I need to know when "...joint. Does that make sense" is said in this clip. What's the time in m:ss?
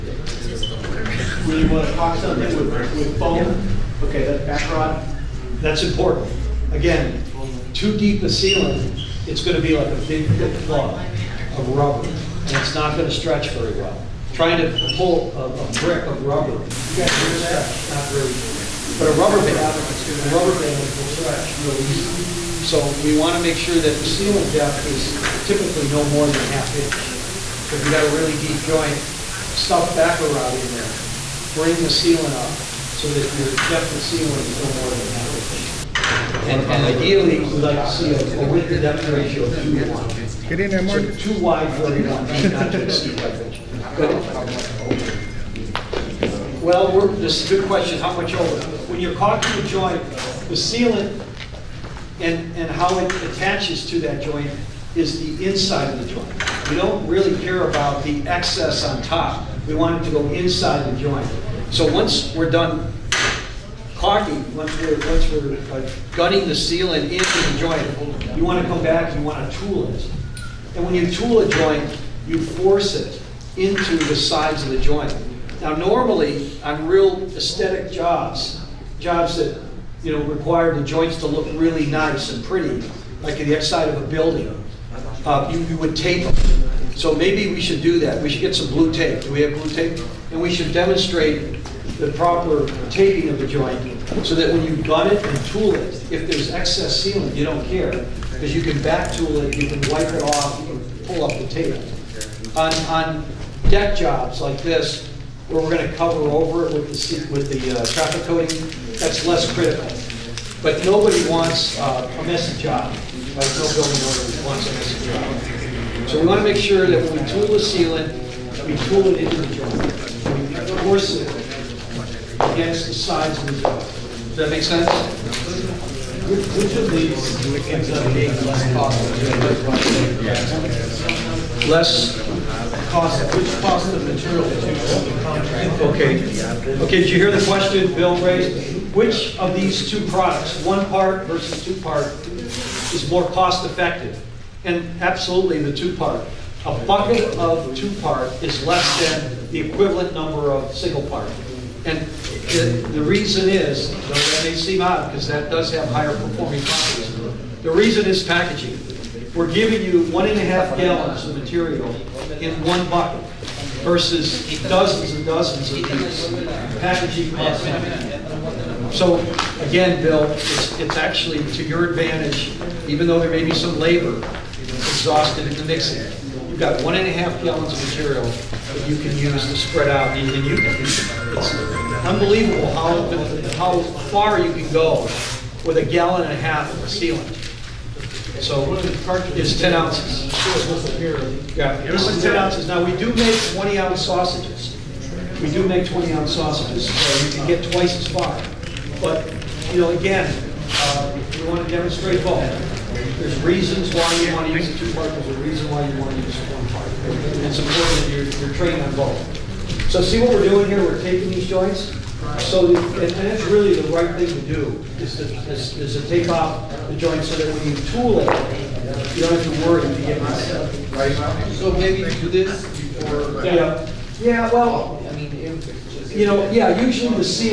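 2:03.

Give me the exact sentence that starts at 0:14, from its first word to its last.
Trying to pull a, a brick of rubber not very.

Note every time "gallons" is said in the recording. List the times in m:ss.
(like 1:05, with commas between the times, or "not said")
2:40, 2:57, 3:05.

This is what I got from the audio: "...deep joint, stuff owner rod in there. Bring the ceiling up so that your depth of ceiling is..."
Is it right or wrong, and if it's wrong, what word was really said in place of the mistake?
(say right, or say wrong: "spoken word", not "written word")
wrong: "backer", not "owner".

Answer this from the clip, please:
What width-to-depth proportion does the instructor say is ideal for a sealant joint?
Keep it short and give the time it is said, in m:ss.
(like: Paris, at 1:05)
2 to 1, at 0:39.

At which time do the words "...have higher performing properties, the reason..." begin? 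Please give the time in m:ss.
2:35.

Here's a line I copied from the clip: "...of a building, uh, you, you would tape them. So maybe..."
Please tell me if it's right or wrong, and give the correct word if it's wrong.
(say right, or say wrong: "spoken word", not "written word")
right.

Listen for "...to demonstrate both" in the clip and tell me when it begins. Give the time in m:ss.
3:21.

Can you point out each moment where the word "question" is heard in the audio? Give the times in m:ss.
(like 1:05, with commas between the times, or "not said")
0:47, 2:17.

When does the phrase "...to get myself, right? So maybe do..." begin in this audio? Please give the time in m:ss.
3:39.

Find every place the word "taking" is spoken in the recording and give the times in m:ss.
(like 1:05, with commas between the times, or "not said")
3:31.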